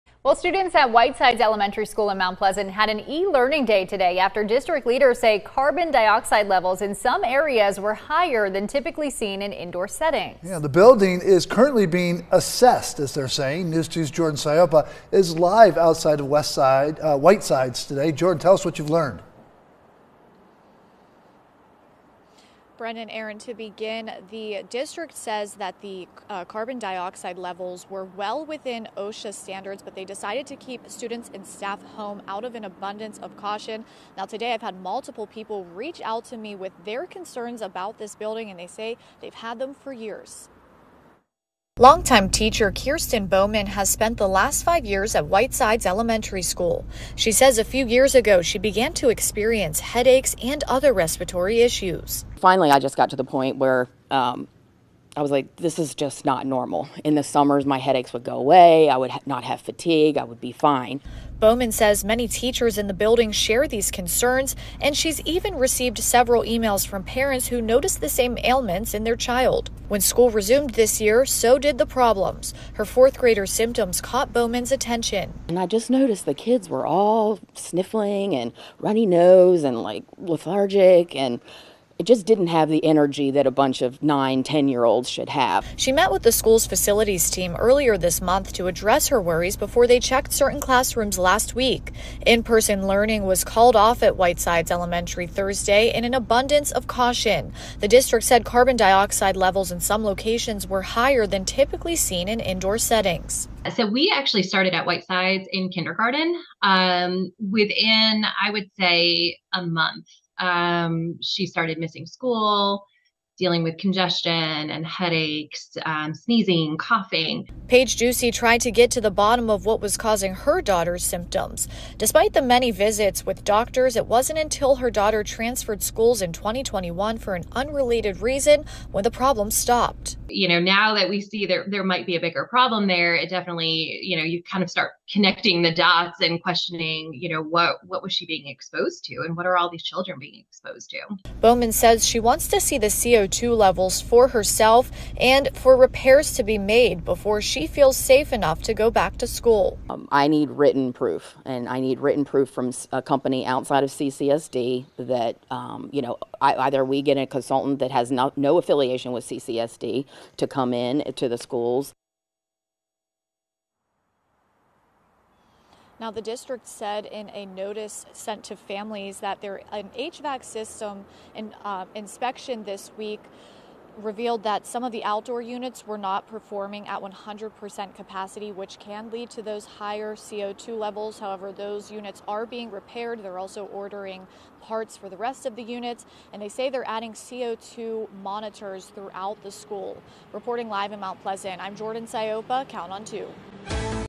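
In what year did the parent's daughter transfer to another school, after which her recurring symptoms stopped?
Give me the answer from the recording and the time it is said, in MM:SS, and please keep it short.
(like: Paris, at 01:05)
2021, at 02:06.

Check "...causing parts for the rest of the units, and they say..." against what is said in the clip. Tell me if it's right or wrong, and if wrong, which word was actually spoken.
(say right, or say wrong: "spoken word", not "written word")
wrong: "ordering", not "causing".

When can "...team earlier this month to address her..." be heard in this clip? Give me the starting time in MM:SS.
01:27.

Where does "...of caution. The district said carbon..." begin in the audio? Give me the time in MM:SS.
01:36.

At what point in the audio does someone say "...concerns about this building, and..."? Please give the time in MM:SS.
00:37.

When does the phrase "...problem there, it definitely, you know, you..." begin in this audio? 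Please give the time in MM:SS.
02:12.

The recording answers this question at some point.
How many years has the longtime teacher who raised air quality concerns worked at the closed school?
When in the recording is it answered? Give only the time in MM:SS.
00:44.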